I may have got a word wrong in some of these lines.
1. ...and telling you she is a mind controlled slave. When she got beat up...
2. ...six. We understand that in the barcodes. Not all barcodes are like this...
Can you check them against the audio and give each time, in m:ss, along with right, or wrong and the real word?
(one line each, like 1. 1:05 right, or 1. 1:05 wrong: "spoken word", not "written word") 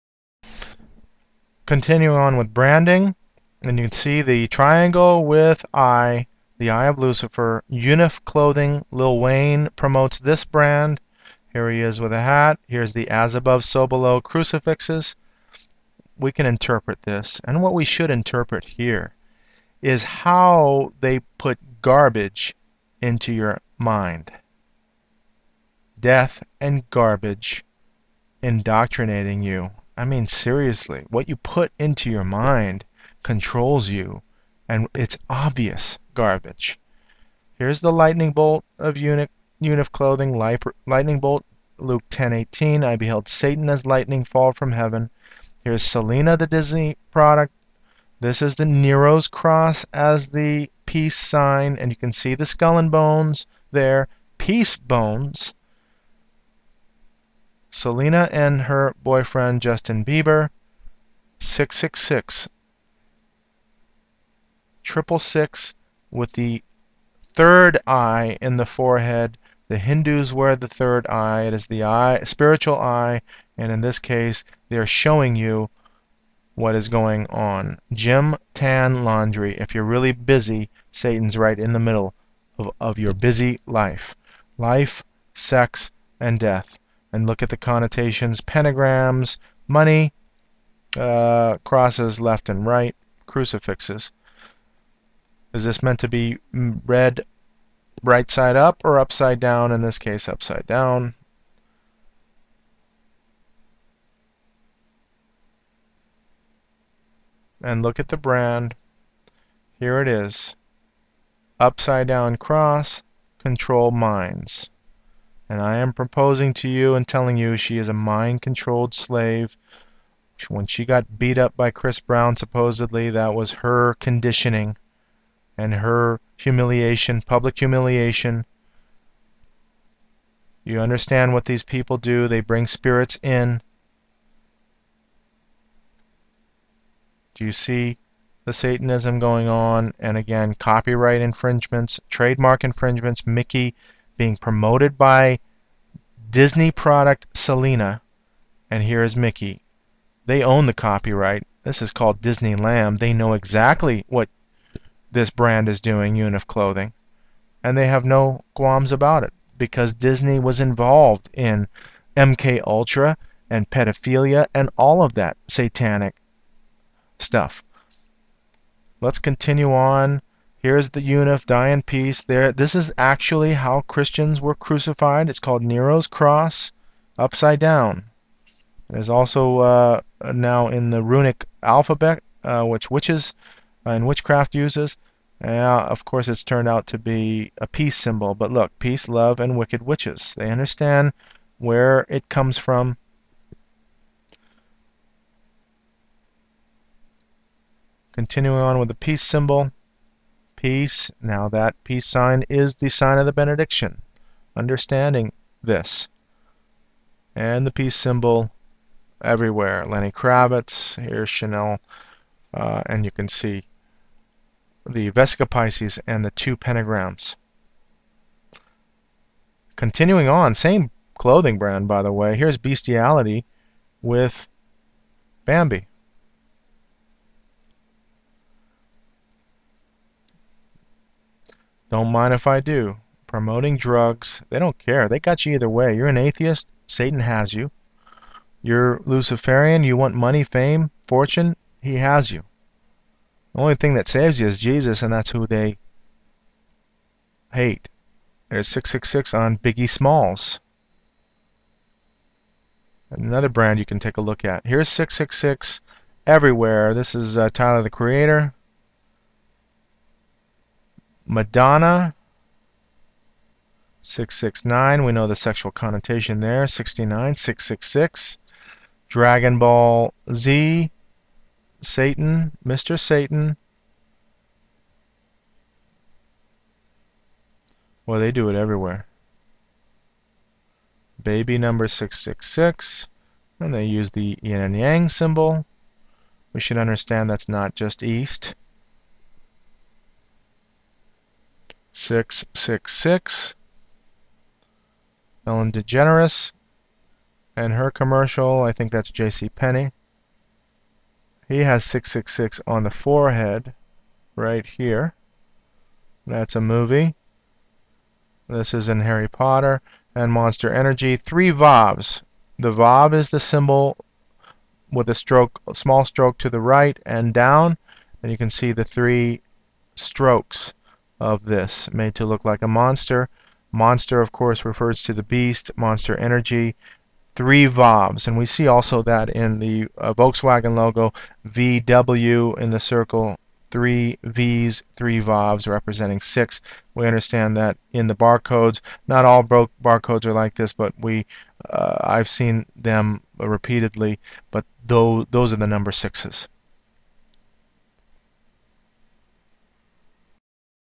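1. 1:56 right
2. 5:36 right.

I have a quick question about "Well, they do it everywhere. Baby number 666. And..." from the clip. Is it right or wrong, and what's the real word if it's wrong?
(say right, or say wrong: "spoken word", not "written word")
right.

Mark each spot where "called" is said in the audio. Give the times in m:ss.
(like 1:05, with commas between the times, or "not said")
2:31, 2:55.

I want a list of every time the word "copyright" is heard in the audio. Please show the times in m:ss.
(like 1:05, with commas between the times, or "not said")
2:20, 2:30.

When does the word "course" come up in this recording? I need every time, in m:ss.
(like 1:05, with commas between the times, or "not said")
3:06, 5:24.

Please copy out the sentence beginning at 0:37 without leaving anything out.
Here's the lightning bolt of eunuch, eunuch clothing, lightning bolt, Luke 10:18.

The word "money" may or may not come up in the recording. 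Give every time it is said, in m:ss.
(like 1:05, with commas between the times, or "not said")
1:29, 4:00.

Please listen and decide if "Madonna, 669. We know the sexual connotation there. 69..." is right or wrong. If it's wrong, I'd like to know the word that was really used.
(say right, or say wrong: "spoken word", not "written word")
right.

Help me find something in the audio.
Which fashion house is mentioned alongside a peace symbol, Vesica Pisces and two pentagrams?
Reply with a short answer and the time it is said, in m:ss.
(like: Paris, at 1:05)
Chanel, at 3:31.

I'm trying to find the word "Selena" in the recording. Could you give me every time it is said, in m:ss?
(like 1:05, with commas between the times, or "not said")
0:45, 0:57, 2:27.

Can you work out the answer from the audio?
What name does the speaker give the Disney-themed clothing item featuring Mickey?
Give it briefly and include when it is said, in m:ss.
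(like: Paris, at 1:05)
Disney Lamb, at 2:32.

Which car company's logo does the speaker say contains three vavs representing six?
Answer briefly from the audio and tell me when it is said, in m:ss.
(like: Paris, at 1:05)
Volkswagen, at 5:30.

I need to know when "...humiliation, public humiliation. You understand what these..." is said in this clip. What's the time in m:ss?
2:06.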